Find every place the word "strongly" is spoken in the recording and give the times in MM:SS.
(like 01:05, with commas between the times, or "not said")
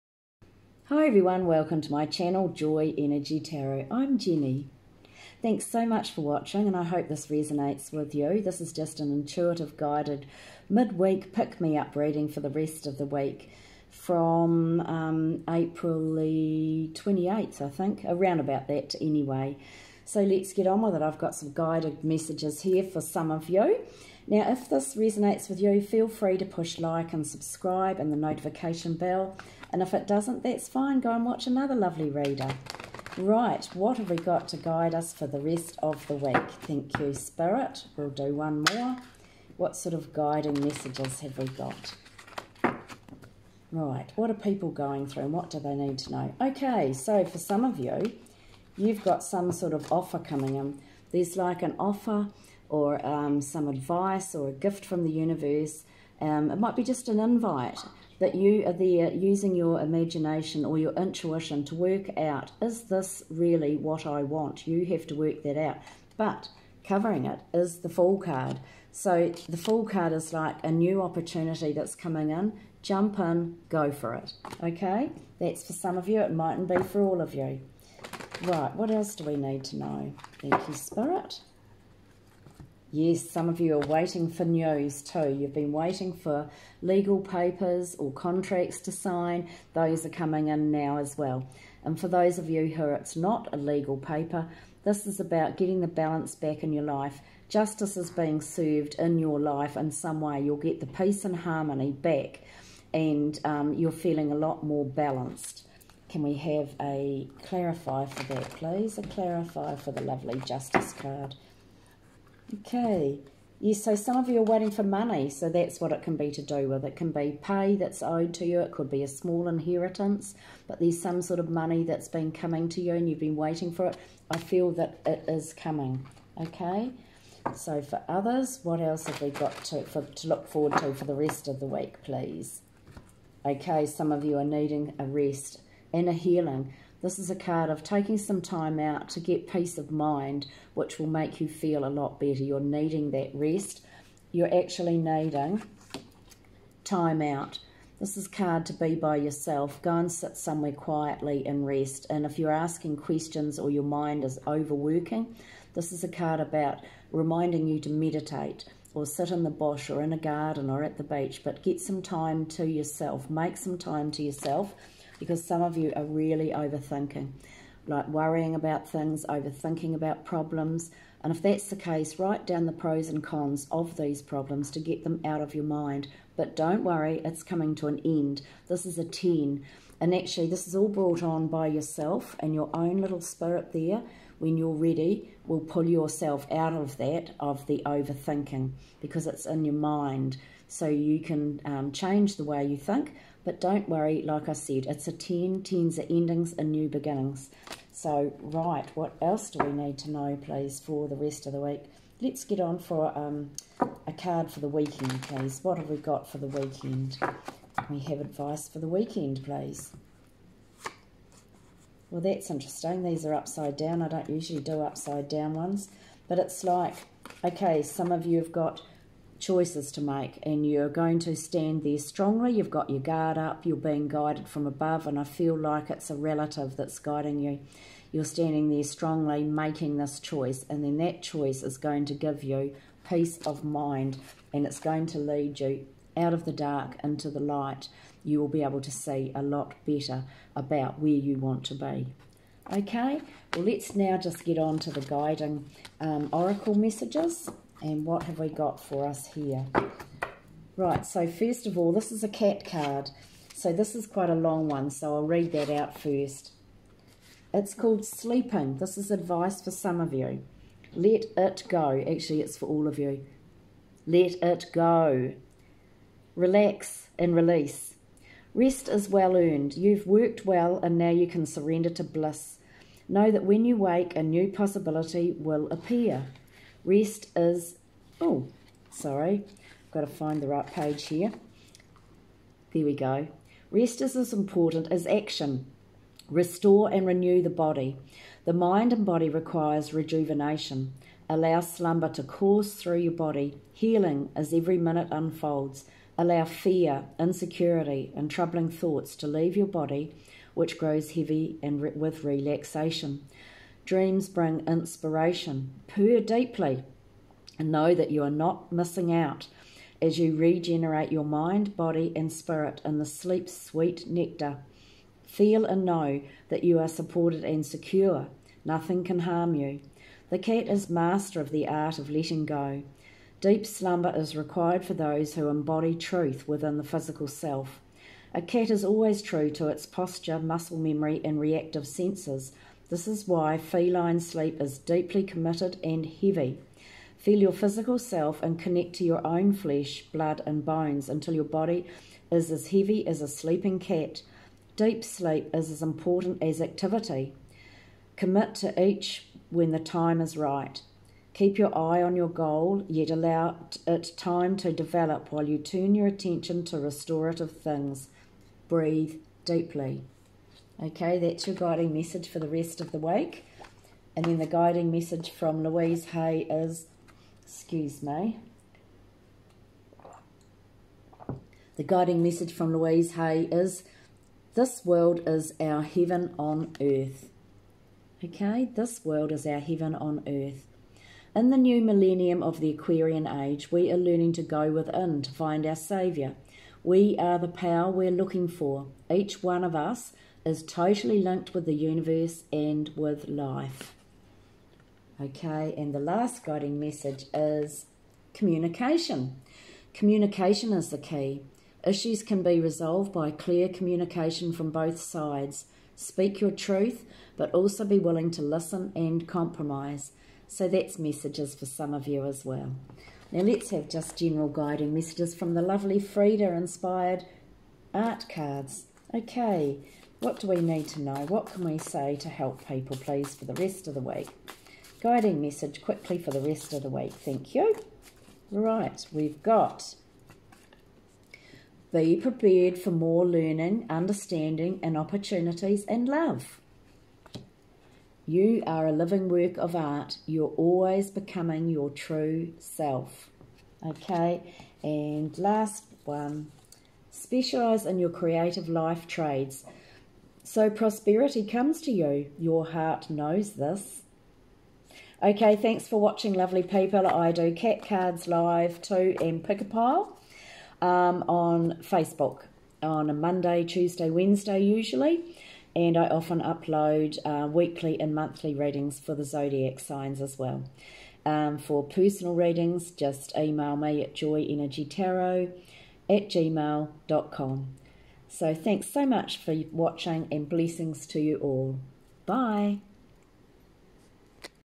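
03:41, 03:48.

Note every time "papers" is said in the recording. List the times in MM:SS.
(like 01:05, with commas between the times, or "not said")
01:27, 01:33.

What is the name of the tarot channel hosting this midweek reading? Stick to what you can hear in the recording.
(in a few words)
Joy Energy Tarot.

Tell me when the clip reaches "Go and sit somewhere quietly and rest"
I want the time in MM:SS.
02:29.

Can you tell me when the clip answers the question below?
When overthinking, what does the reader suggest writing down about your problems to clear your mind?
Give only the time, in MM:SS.
02:52.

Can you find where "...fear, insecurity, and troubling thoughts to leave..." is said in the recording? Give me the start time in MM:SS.
04:56.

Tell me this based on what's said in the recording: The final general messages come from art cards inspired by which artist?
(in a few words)
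Frida.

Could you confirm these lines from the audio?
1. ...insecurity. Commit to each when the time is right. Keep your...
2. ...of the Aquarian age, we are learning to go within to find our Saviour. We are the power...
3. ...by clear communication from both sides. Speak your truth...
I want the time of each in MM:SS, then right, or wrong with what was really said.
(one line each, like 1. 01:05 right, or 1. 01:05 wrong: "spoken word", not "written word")
1. 05:46 wrong: "activity", not "insecurity"
2. 06:22 right
3. 06:43 right.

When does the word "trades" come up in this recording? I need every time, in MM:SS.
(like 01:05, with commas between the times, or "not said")
07:29.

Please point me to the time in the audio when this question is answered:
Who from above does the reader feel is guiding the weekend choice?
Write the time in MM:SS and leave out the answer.
03:46.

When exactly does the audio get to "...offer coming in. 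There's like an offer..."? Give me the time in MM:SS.
00:49.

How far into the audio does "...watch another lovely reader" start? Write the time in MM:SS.
00:31.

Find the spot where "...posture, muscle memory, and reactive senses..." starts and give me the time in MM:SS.
05:29.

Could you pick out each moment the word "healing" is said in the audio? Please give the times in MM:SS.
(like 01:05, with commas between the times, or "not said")
02:16, 04:53.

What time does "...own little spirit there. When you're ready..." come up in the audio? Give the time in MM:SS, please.
03:02.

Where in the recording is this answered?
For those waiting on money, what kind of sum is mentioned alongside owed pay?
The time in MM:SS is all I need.
01:59.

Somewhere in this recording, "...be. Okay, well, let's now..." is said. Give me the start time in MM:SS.
04:01.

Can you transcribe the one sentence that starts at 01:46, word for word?
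Can we have a clarify for that, please?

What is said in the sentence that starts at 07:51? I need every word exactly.
Um, for personal readings, just email me at joyenergytarot at gmail.com.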